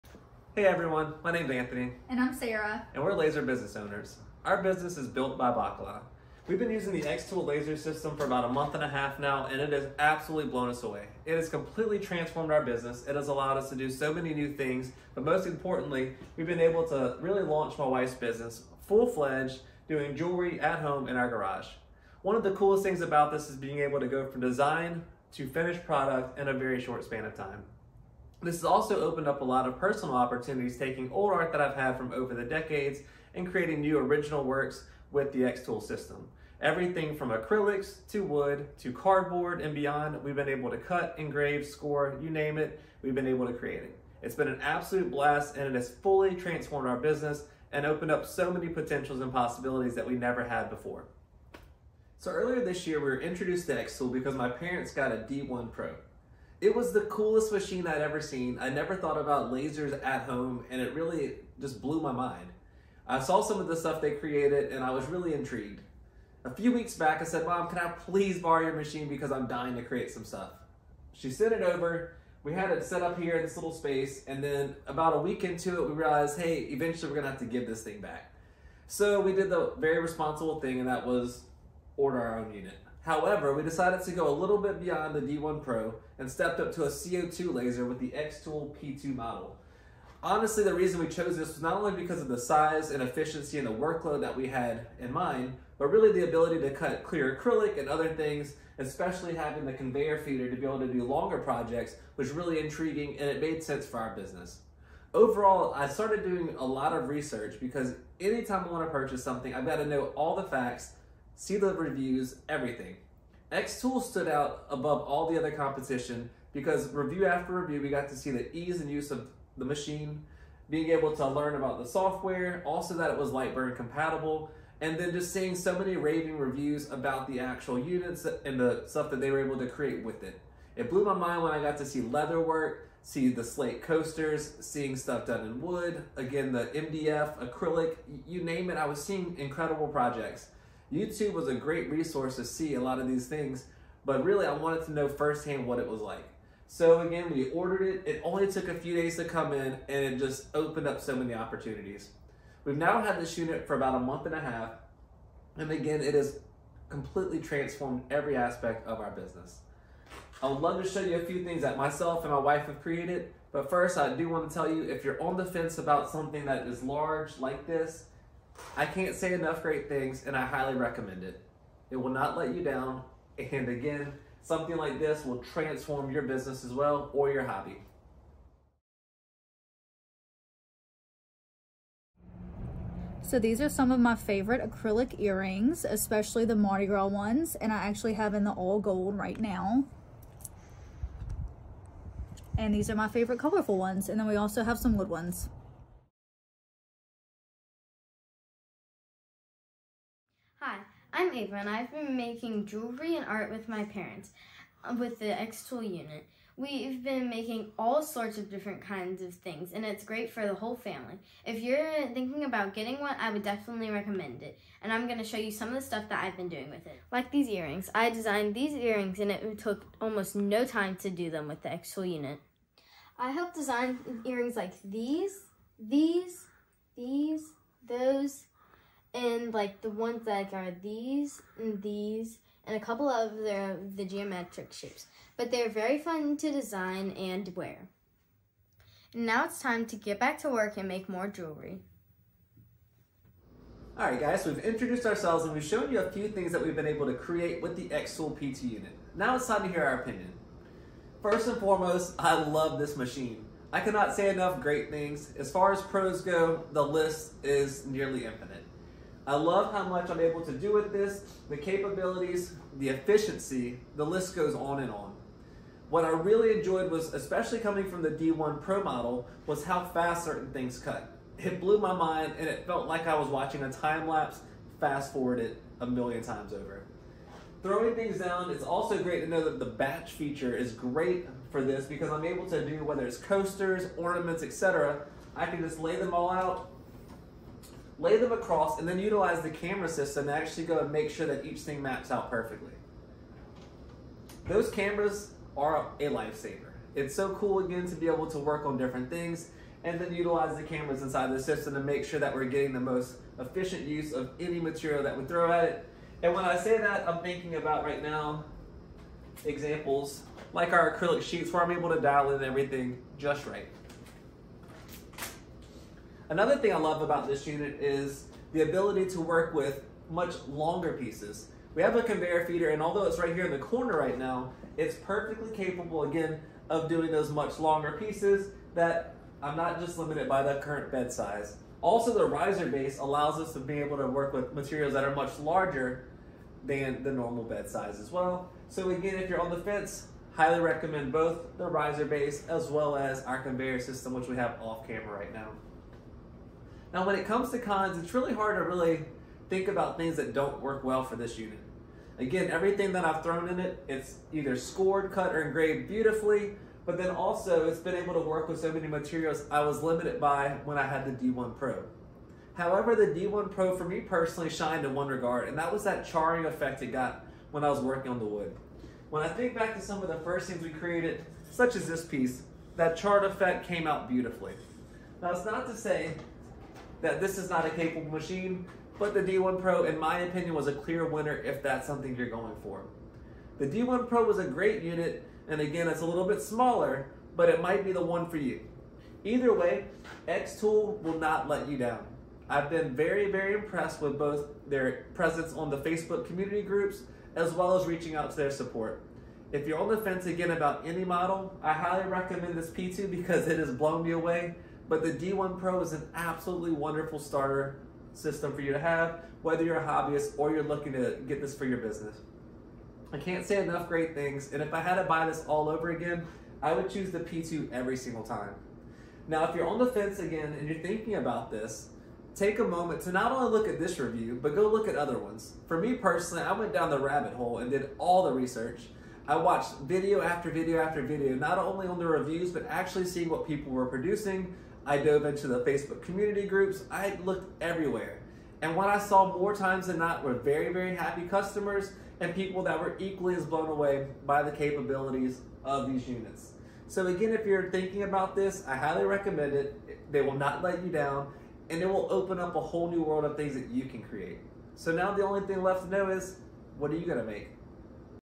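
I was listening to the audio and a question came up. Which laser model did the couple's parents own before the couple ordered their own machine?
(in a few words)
D1 Pro.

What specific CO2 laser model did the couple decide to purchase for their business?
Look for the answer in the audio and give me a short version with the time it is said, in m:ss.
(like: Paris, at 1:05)
P2, at 1:28.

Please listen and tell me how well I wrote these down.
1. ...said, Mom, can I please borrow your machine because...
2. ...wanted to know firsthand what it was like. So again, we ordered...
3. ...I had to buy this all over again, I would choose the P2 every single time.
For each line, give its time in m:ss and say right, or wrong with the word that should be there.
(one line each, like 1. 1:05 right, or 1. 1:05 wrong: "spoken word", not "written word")
1. 1:07 right
2. 2:24 right
3. 6:54 right.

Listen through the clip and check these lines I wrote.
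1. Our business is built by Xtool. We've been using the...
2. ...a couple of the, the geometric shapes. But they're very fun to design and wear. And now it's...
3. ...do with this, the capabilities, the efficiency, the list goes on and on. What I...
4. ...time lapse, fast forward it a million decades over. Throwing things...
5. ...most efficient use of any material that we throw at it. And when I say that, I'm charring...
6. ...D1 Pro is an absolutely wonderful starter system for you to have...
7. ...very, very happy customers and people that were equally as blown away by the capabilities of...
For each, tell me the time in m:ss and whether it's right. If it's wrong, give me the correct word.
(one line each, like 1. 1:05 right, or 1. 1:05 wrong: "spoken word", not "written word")
1. 0:04 wrong: "Bacala", not "Xtool"
2. 3:52 right
3. 4:20 right
4. 4:33 wrong: "times", not "decades"
5. 5:02 wrong: "thinking", not "charring"
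6. 6:45 right
7. 7:20 right.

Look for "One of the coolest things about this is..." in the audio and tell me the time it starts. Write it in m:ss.
0:22.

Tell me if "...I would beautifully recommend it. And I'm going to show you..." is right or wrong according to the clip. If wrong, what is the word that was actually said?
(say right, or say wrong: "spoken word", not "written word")
wrong: "definitely", not "beautifully".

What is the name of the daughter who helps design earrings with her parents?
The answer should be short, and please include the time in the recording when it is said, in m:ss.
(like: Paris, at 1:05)
Ava, at 3:21.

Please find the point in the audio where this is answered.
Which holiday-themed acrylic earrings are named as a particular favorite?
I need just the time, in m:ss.
3:06.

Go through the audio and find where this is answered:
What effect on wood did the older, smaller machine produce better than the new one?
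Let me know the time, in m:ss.
6:06.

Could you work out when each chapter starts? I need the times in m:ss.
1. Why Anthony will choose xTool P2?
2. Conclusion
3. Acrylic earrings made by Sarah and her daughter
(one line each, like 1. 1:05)
1. 0:52
2. 4:03
3. 2:58.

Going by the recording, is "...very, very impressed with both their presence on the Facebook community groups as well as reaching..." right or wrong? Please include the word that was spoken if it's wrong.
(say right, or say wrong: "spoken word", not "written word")
right.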